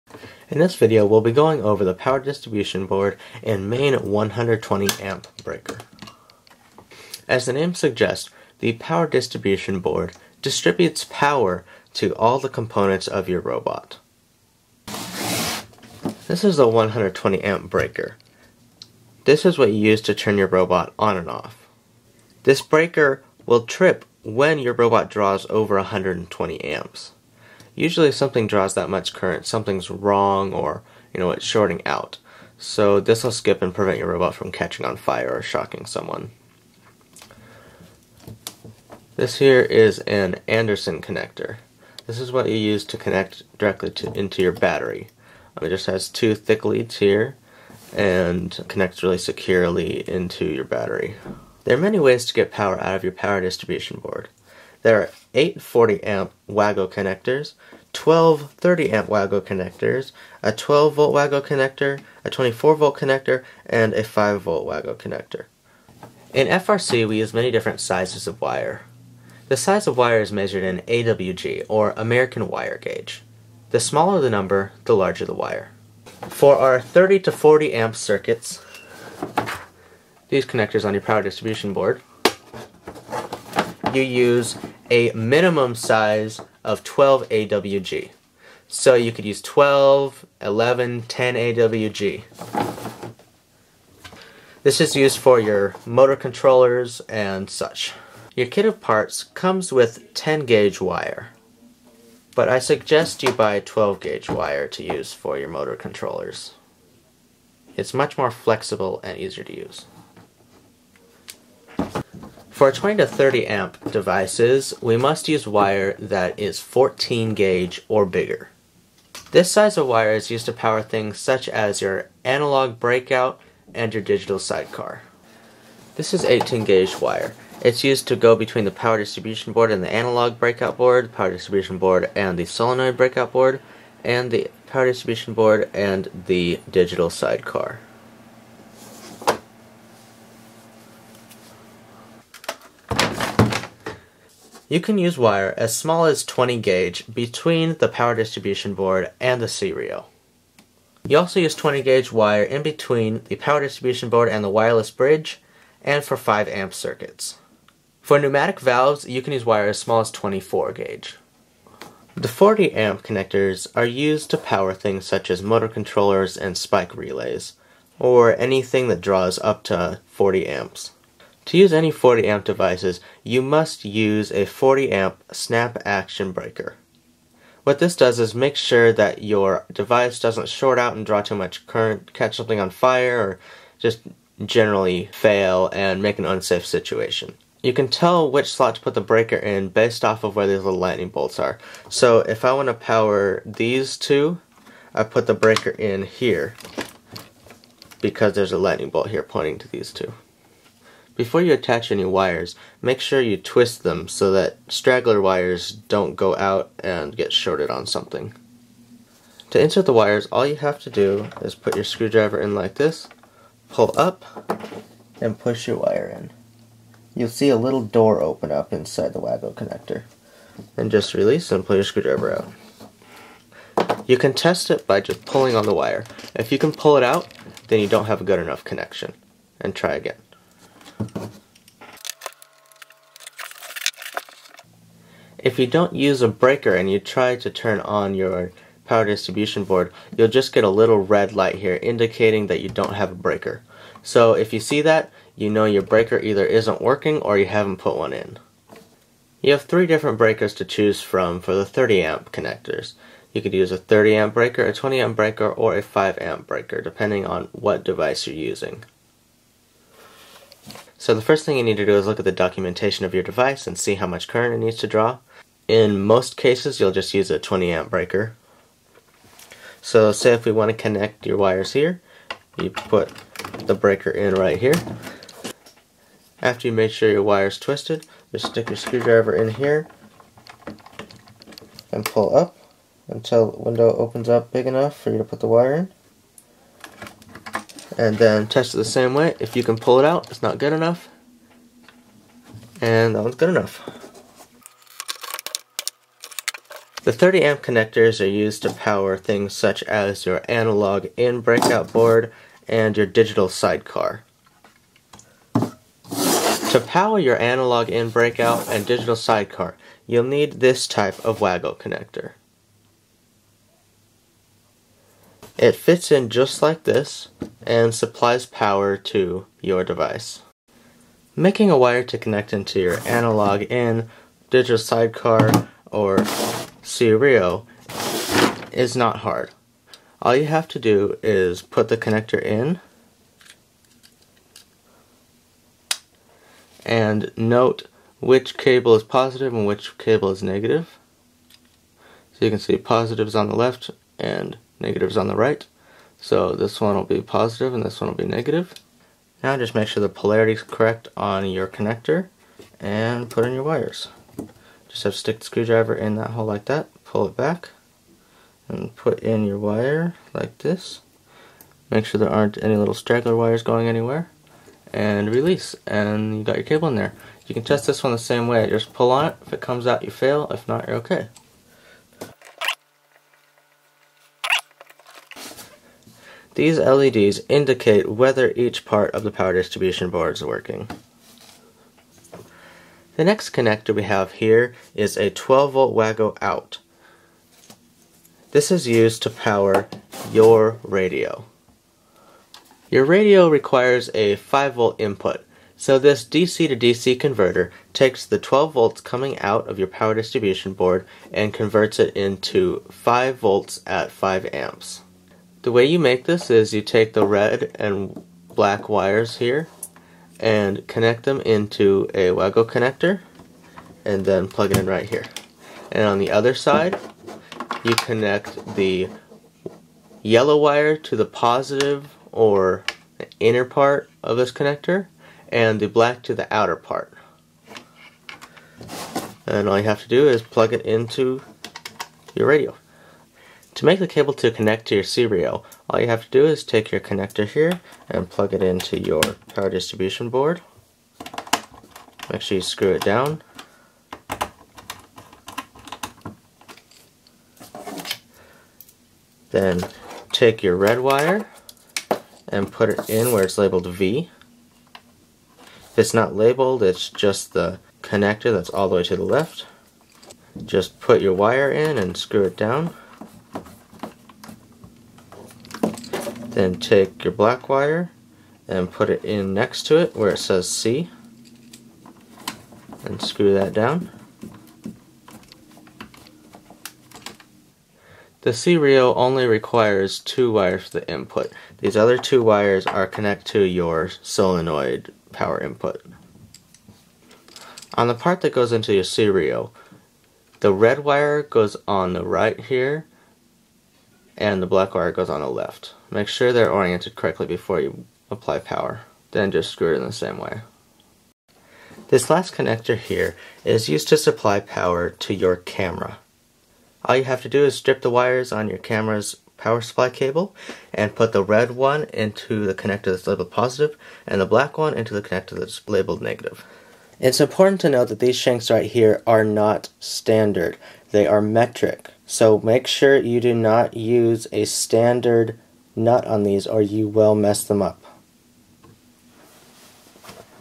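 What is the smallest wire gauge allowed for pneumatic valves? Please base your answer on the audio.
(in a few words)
24 gauge.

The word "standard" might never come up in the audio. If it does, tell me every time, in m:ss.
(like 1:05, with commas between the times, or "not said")
8:40, 8:44.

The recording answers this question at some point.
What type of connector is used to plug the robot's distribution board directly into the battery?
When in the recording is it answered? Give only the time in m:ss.
0:40.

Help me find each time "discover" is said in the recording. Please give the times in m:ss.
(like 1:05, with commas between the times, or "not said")
not said.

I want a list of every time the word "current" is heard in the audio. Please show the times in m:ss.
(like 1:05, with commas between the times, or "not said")
0:29, 3:01, 4:24.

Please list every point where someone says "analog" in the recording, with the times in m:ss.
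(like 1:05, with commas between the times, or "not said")
2:02, 2:09, 5:00, 5:07, 5:23.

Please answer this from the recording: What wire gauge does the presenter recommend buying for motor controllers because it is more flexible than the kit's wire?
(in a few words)
12 gauge.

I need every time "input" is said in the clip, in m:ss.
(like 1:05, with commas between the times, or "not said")
6:35, 8:01, 8:05.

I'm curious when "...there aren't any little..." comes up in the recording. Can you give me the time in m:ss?
6:02.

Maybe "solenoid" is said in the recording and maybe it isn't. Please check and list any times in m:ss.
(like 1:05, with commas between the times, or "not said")
2:12, 8:04.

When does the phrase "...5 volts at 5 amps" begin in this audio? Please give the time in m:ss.
6:42.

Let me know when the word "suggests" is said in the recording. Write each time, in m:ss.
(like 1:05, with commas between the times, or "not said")
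0:07, 1:42.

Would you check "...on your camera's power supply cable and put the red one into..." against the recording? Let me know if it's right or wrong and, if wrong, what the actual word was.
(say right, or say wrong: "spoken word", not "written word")
right.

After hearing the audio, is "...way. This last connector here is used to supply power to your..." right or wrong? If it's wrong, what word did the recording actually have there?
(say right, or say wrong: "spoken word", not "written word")
right.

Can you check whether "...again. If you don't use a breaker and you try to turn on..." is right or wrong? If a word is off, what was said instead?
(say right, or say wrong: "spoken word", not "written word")
right.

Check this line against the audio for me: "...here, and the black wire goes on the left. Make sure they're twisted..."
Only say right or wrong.
wrong.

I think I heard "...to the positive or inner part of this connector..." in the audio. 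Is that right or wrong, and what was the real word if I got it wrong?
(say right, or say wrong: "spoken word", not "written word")
right.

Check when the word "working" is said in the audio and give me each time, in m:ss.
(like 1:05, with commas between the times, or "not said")
4:06, 6:20.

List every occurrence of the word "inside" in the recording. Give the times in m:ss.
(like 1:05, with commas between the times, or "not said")
3:38.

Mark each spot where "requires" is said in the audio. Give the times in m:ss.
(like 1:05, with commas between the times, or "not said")
6:33, 7:59.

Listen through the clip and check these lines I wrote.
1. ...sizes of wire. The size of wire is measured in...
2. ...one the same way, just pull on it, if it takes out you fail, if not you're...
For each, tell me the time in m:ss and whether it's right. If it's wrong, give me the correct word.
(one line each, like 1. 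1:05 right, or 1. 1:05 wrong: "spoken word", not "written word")
1. 1:07 right
2. 6:08 wrong: "comes", not "takes".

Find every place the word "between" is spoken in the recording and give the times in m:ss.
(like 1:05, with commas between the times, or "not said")
2:08, 2:27, 2:32.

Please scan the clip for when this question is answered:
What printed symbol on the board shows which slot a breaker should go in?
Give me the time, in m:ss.
3:10.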